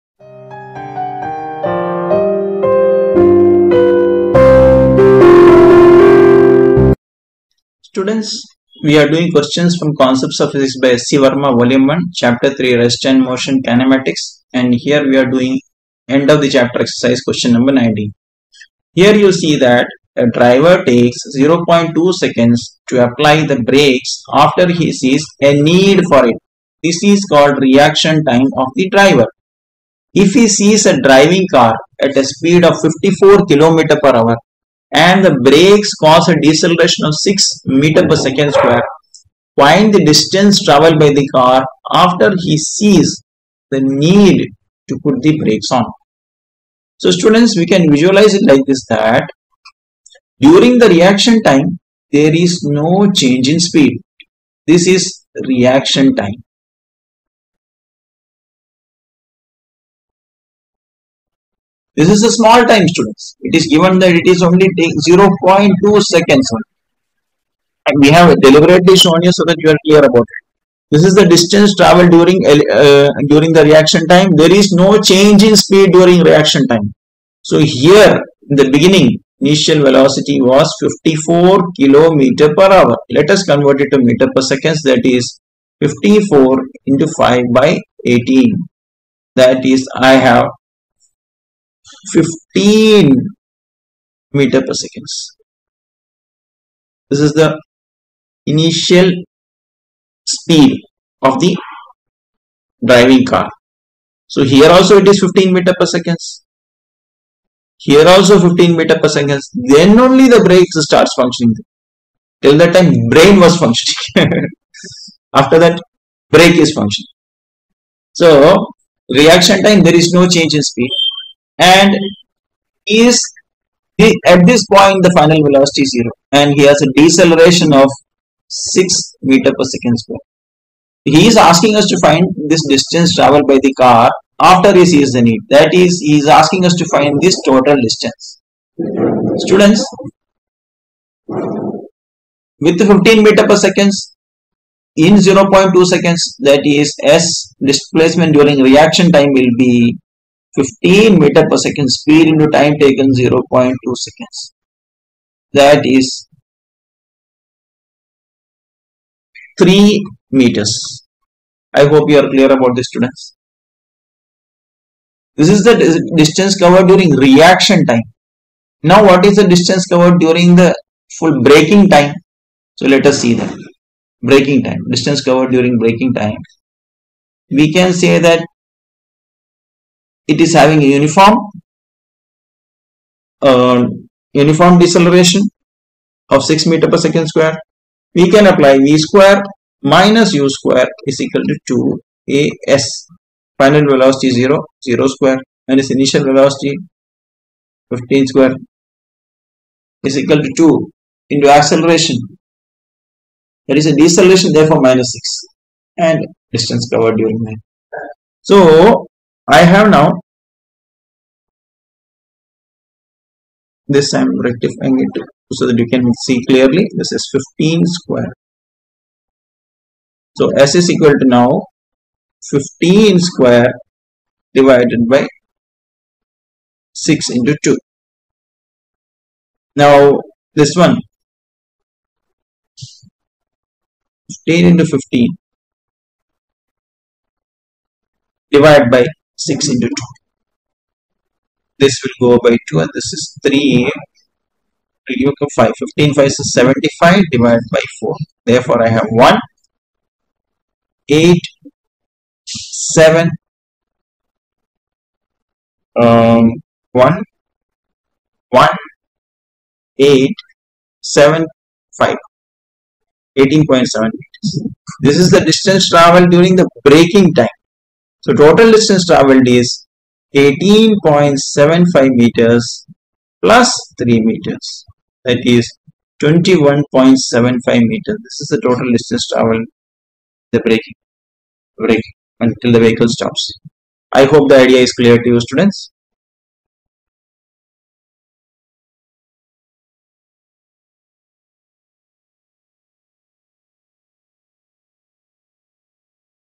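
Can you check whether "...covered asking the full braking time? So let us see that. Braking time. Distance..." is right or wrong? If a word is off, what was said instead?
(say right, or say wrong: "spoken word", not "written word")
wrong: "during", not "asking".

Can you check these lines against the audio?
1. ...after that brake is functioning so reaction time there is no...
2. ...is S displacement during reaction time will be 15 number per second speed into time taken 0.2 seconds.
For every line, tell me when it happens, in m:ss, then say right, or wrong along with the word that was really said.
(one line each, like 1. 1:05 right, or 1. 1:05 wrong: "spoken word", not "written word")
1. 1:55 right
2. 2:26 wrong: "meter", not "number".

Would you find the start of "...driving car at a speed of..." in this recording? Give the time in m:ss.
0:31.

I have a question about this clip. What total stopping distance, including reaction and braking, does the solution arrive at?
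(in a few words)
21.75 meters.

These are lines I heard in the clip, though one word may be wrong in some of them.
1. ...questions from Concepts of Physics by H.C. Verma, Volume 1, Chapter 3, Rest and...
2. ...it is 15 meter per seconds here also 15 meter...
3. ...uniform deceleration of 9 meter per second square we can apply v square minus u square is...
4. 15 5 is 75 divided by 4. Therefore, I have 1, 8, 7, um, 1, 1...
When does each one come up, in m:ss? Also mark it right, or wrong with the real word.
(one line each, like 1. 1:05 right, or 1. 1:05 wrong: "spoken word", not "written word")
1. 0:09 right
2. 1:45 right
3. 3:04 wrong: "6", not "9"
4. 4:05 right.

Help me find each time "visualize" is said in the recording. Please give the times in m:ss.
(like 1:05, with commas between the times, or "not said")
0:47.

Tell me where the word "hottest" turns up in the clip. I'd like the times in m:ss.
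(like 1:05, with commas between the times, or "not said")
not said.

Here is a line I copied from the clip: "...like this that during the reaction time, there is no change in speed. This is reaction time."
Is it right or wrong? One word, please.
right.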